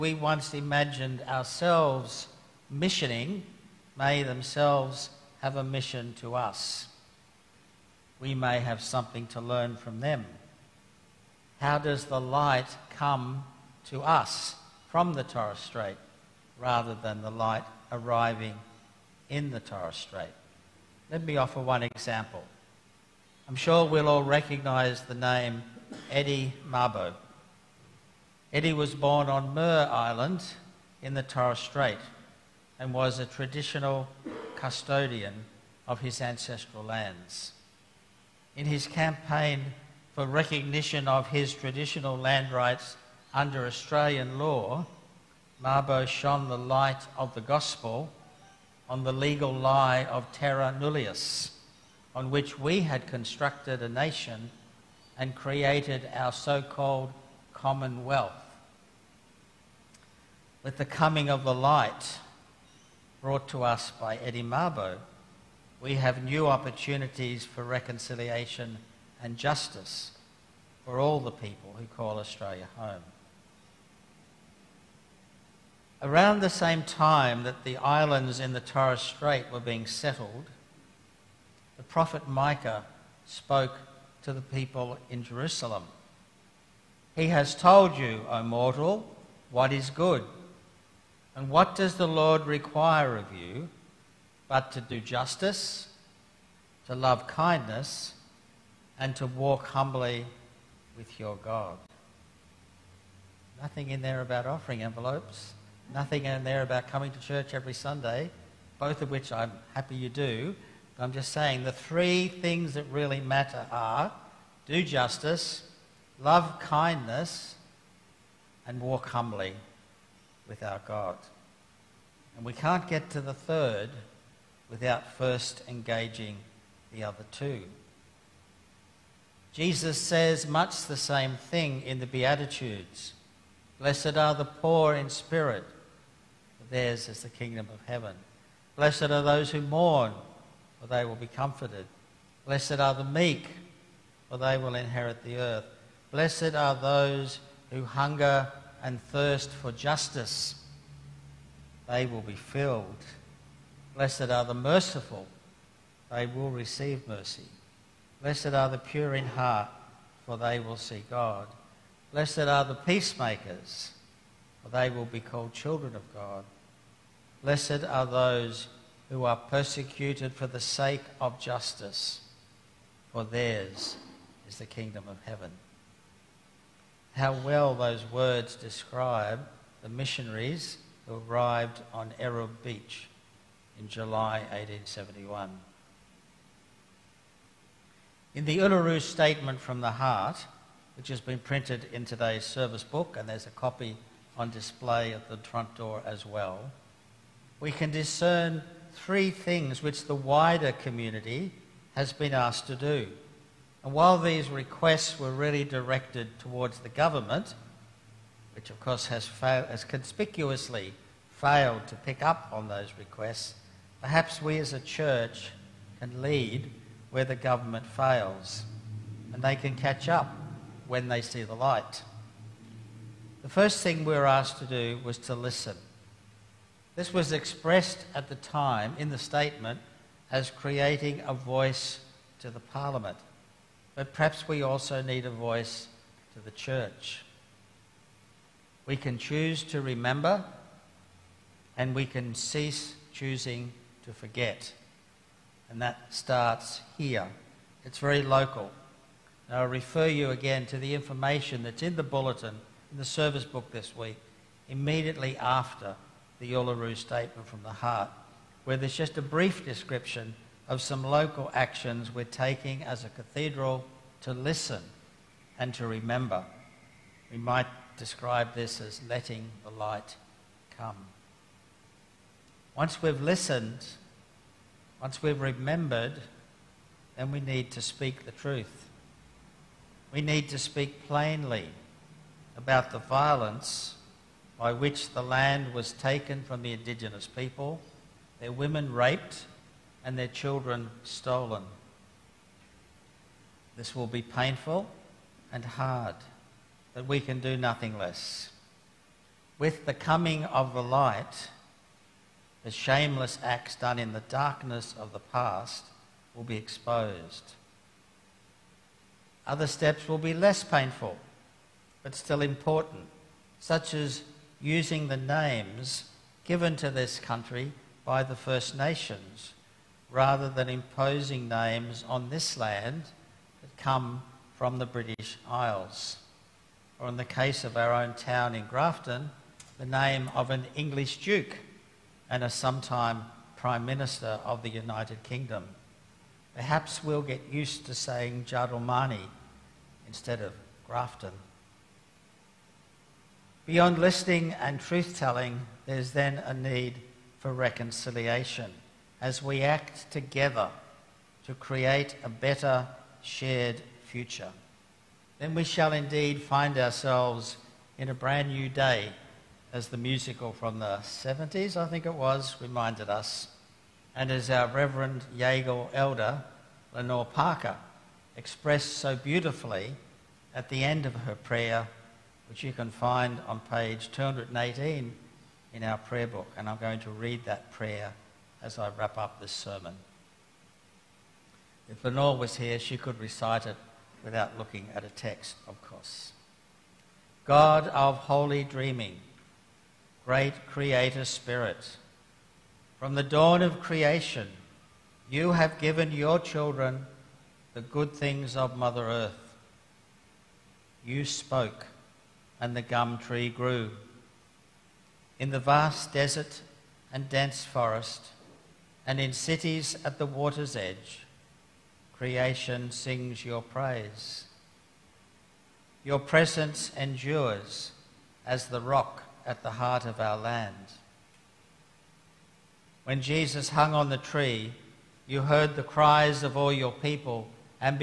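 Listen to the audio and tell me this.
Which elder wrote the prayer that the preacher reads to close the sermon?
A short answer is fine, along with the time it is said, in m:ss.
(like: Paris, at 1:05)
Lenore Parker, at 6:06.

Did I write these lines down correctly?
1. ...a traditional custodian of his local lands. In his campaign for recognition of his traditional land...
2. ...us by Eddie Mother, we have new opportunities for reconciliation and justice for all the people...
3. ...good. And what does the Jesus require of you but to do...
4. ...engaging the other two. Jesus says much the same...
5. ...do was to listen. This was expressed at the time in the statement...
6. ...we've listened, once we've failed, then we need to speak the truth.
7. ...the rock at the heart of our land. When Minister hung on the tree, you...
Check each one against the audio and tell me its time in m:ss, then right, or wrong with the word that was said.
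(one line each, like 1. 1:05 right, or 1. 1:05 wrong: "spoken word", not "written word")
1. 0:33 wrong: "ancestral", not "local"
2. 1:03 wrong: "Mabo", not "Mother"
3. 1:29 wrong: "Lord", not "Jesus"
4. 2:05 right
5. 3:44 right
6. 4:33 wrong: "remembered", not "failed"
7. 6:58 wrong: "Jesus", not "Minister".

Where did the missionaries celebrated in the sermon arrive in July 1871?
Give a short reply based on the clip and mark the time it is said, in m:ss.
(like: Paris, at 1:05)
Arab Beach, at 3:02.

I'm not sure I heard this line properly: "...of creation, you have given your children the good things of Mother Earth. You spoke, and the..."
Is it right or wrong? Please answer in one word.
right.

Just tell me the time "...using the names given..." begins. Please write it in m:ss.
5:14.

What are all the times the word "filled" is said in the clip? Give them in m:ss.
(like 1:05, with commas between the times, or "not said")
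2:32.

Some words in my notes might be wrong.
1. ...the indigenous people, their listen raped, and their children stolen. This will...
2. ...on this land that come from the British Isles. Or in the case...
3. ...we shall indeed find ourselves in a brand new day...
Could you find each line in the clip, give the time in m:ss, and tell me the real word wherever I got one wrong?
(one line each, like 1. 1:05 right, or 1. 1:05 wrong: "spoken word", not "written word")
1. 4:46 wrong: "women", not "listen"
2. 5:22 right
3. 5:55 right.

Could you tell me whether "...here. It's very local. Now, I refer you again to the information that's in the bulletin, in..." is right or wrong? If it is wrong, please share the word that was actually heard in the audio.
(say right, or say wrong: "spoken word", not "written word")
right.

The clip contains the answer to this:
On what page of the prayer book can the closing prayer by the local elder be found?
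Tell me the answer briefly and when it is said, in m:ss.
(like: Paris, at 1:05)
218, at 6:14.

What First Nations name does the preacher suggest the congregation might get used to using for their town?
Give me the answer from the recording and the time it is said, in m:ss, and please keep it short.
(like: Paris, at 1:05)
Jadalmany, at 5:38.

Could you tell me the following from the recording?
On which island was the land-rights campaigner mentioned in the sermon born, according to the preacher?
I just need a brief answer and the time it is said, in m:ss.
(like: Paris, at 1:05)
Mer Island, at 0:29.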